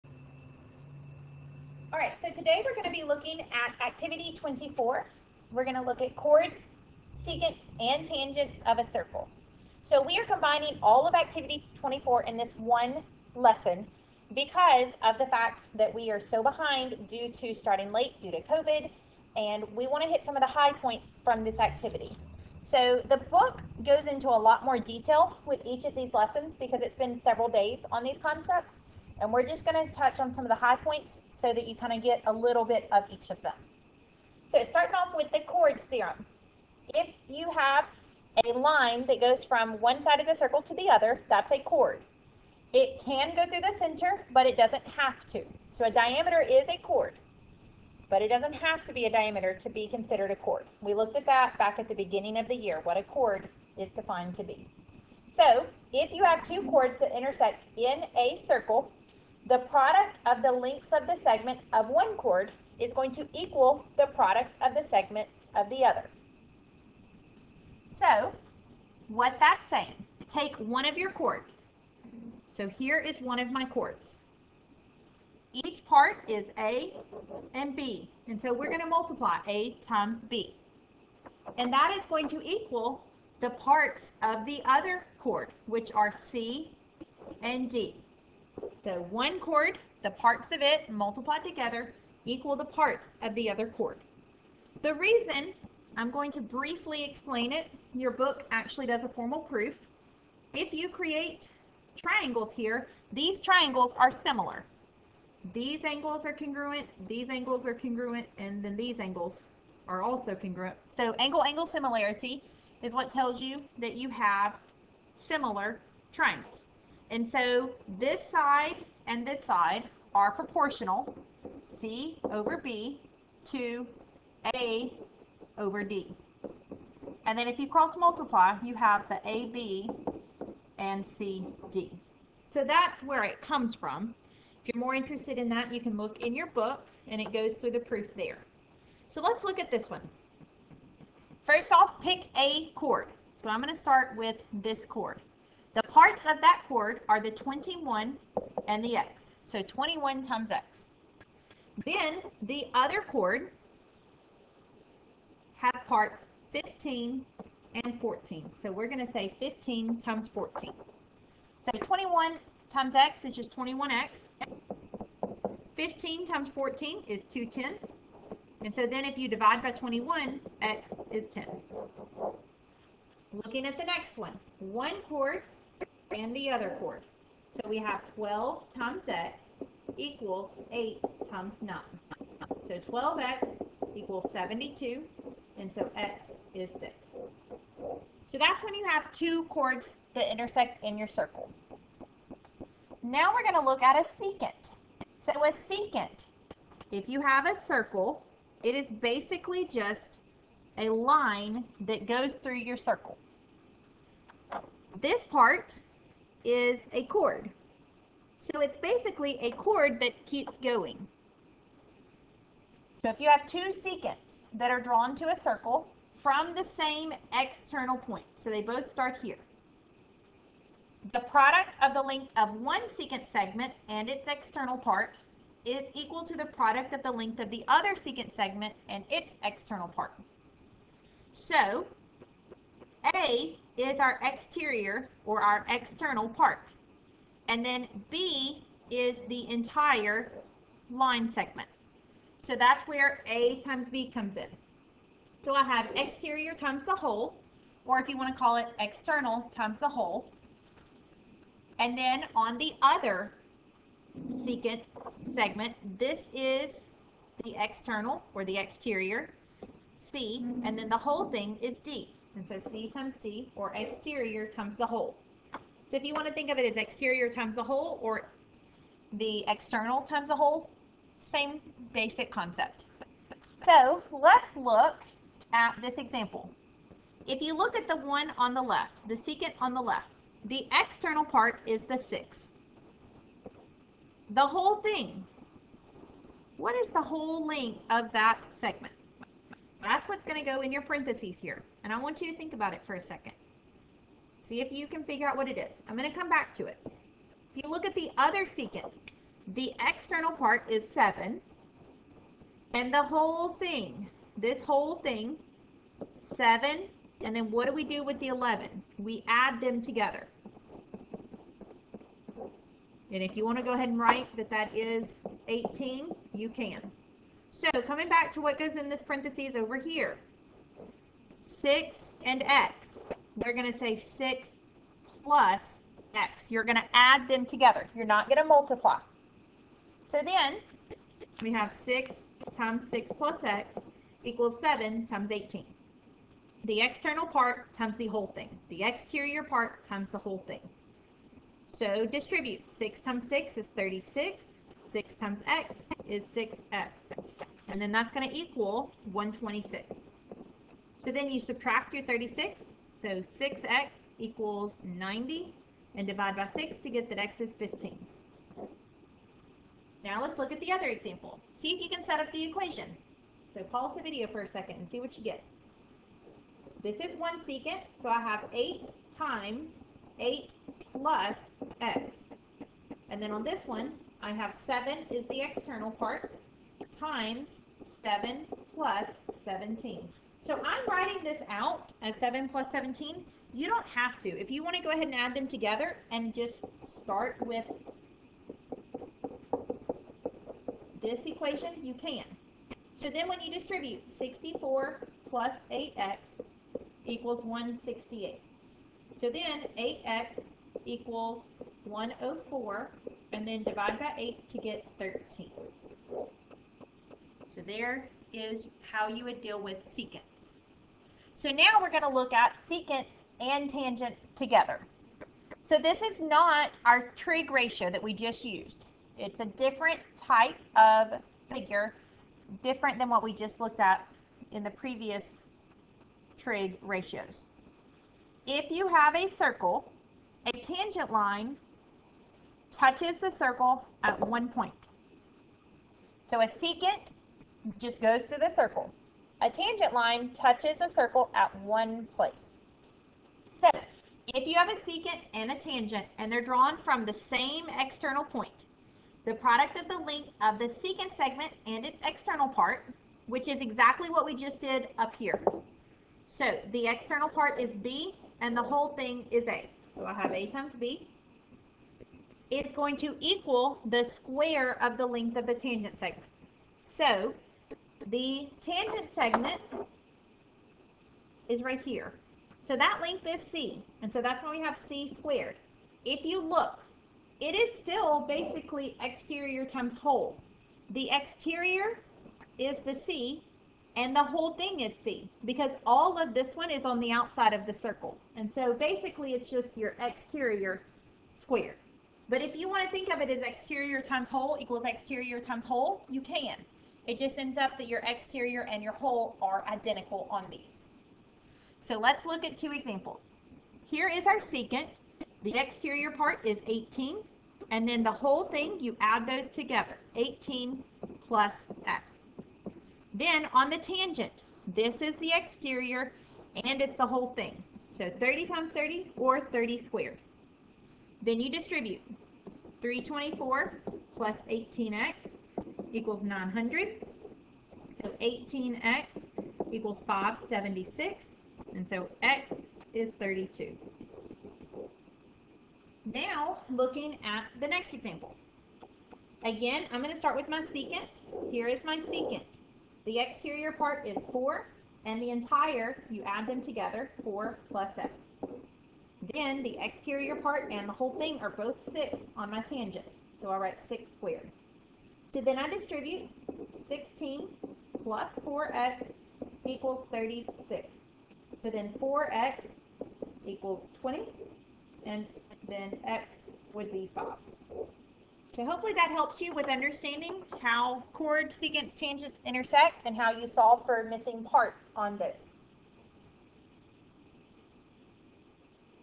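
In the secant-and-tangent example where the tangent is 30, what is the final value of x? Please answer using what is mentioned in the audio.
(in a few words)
32.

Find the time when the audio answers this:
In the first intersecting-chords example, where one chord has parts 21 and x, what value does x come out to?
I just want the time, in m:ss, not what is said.
2:50.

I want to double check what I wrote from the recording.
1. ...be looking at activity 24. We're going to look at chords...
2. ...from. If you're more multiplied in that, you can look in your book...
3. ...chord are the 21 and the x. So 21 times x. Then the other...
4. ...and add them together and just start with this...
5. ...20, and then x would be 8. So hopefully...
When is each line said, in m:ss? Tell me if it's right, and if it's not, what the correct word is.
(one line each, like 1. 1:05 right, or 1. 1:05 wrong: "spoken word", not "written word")
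1. 0:03 right
2. 2:13 wrong: "interested", not "multiplied"
3. 2:26 right
4. 6:25 right
5. 9:24 wrong: "5", not "8".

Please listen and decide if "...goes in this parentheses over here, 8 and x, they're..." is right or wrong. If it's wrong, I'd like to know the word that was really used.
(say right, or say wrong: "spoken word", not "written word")
wrong: "6", not "8".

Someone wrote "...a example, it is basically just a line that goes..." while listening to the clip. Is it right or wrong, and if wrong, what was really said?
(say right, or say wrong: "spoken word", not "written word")
wrong: "circle", not "example".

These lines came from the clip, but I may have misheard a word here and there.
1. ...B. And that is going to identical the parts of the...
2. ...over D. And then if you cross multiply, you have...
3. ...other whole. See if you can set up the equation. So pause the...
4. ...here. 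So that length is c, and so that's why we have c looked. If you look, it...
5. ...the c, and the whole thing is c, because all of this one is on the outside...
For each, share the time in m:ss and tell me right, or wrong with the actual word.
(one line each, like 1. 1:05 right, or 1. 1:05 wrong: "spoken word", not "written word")
1. 1:20 wrong: "equal", not "identical"
2. 2:05 right
3. 6:00 wrong: "example", not "whole"
4. 7:51 wrong: "squared", not "looked"
5. 8:02 right.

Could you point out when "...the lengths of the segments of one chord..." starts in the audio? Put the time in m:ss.
1:00.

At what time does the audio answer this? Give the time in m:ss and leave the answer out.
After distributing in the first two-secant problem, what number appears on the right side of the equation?
5:49.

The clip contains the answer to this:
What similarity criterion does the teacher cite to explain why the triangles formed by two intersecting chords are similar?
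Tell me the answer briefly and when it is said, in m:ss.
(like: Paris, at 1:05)
Angle-angle similarity, at 1:51.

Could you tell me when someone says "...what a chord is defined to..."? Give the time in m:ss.
0:52.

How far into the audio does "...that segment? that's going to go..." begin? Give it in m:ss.
4:48.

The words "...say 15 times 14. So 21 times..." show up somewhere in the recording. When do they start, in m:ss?
2:39.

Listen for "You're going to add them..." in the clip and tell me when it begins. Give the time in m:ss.
5:26.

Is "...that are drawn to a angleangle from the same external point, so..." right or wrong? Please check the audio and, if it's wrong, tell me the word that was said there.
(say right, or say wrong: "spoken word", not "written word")
wrong: "circle", not "angleangle".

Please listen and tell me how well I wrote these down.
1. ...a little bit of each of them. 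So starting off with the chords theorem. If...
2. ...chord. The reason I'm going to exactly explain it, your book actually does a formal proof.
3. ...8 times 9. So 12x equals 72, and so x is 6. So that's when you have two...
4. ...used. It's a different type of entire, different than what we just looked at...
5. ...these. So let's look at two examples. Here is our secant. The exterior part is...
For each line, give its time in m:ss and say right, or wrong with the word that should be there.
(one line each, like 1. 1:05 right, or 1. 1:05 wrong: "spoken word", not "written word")
1. 0:32 right
2. 1:33 wrong: "briefly", not "exactly"
3. 3:00 right
4. 6:58 wrong: "figure", not "entire"
5. 8:20 right.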